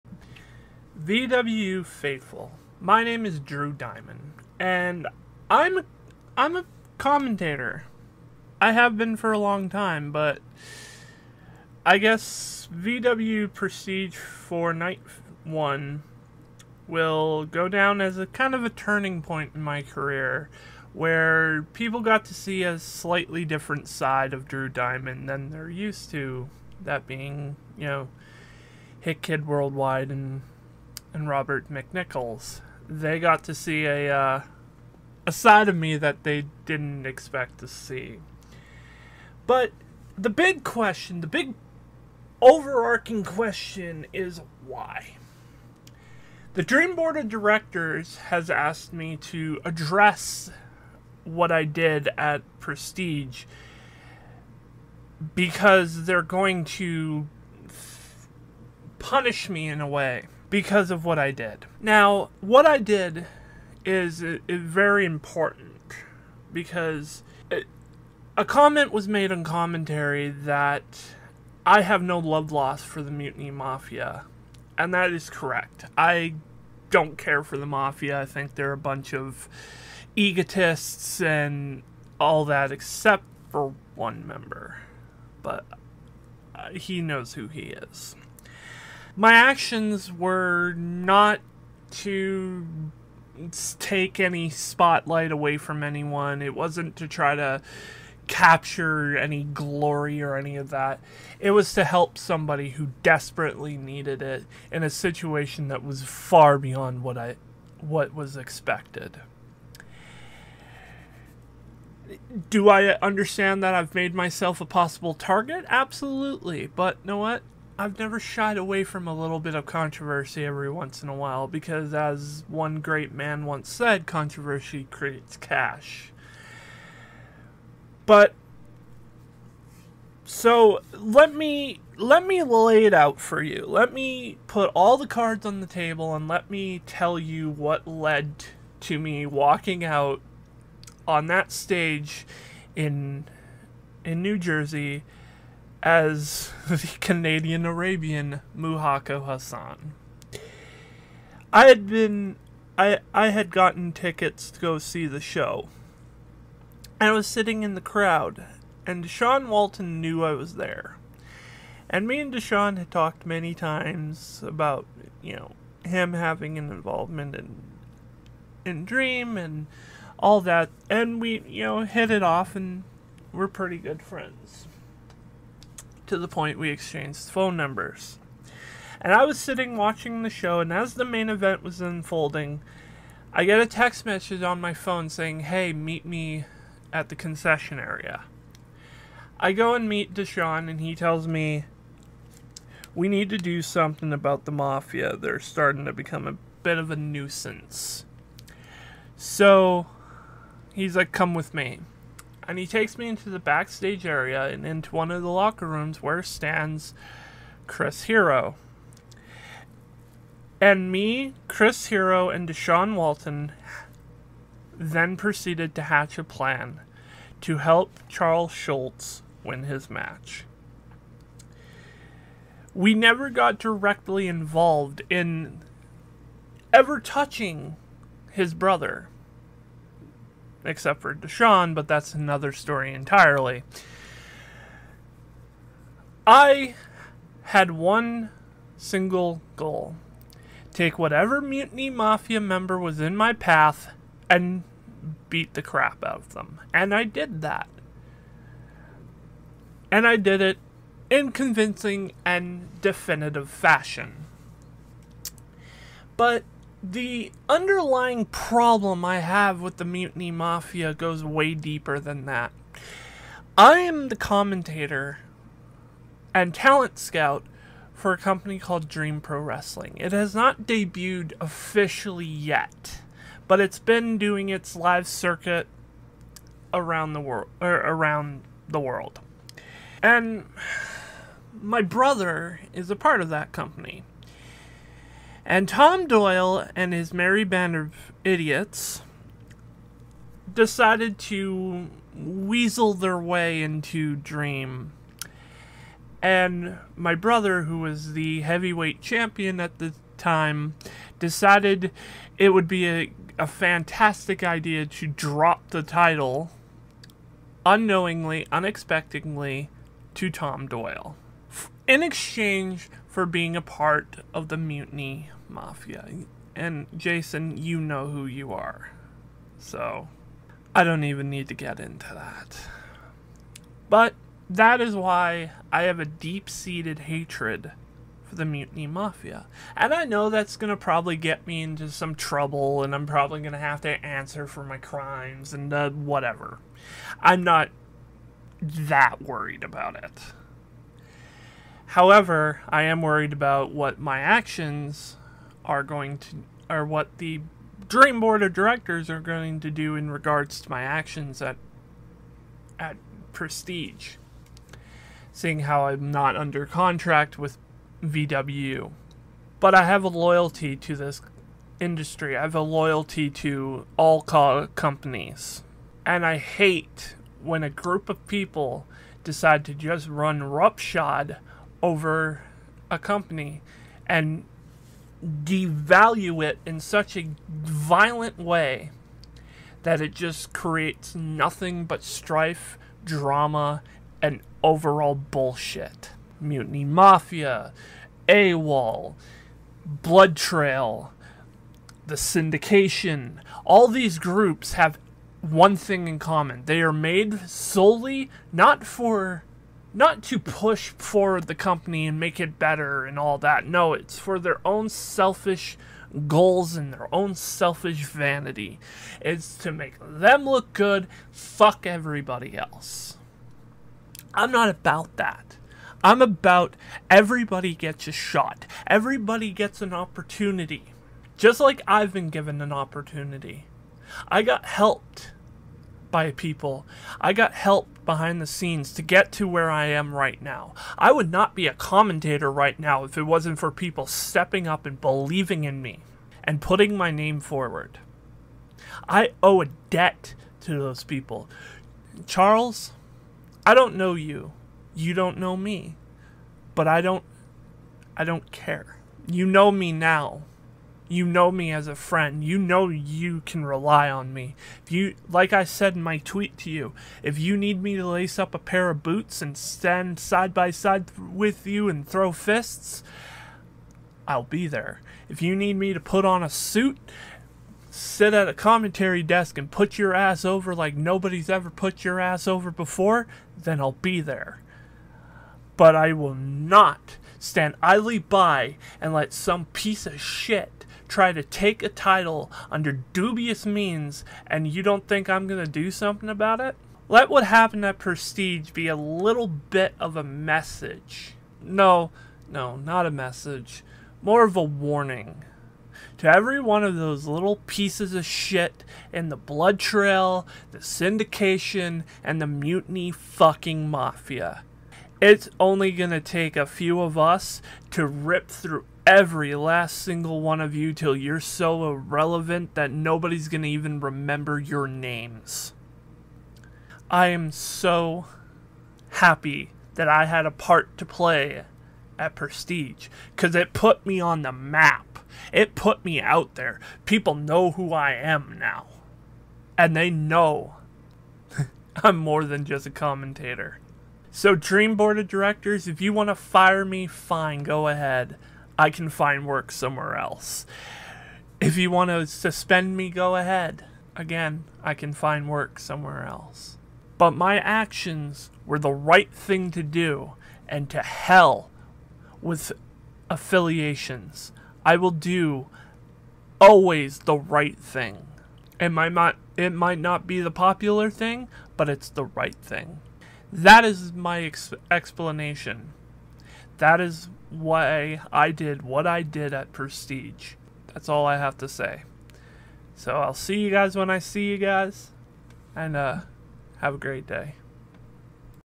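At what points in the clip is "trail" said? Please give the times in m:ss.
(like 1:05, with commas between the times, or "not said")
6:30, 8:19.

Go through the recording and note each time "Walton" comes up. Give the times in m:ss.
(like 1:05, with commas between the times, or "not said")
2:39, 3:32.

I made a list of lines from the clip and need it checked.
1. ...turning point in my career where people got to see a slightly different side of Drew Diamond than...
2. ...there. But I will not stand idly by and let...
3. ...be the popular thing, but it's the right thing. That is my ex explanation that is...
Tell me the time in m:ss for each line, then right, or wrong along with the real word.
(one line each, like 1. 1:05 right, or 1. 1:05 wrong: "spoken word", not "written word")
1. 0:18 right
2. 7:54 right
3. 9:20 right.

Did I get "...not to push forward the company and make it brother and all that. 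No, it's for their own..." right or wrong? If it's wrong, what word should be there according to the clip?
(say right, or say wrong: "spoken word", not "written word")
wrong: "better", not "brother".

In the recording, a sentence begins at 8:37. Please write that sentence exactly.
I am so happy that I had a part to play at Prestige because it put me on the map.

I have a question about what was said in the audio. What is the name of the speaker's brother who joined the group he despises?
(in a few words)
Jason.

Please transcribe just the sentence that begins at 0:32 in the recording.
They got to see a uh, a side of me that they didn't expect to see.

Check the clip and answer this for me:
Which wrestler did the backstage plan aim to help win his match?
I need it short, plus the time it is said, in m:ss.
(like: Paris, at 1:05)
Charles Schultz, at 3:38.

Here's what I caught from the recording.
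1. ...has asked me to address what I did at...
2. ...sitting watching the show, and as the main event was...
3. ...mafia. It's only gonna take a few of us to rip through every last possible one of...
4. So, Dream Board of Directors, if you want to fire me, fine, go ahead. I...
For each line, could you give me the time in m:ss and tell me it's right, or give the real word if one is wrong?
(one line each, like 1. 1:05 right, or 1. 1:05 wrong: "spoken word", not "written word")
1. 0:48 right
2. 2:59 right
3. 8:23 wrong: "single", not "possible"
4. 8:54 right.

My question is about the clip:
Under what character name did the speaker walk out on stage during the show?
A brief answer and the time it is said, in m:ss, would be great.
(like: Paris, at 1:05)
Muhako Hassan, at 2:28.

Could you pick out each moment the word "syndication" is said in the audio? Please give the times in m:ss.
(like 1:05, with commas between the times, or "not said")
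6:32, 8:20.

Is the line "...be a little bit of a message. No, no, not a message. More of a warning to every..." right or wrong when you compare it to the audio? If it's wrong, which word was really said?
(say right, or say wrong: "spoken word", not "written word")
right.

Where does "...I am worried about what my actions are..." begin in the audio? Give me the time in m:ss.
5:42.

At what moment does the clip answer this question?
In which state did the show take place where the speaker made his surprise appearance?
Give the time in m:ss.
2:24.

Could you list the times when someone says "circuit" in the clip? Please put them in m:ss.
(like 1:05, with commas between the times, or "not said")
4:35.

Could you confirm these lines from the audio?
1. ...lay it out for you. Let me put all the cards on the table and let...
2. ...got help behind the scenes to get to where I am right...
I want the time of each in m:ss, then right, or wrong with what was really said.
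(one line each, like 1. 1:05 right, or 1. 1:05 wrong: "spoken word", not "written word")
1. 2:12 right
2. 7:07 right.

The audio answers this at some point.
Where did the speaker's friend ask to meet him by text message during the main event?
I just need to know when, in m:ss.
3:07.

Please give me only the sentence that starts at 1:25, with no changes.
But he knows who he is my actions were not to take any spotlight away from anyone.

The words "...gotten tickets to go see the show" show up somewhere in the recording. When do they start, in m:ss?
2:33.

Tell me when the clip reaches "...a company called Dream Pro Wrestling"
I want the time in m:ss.
4:28.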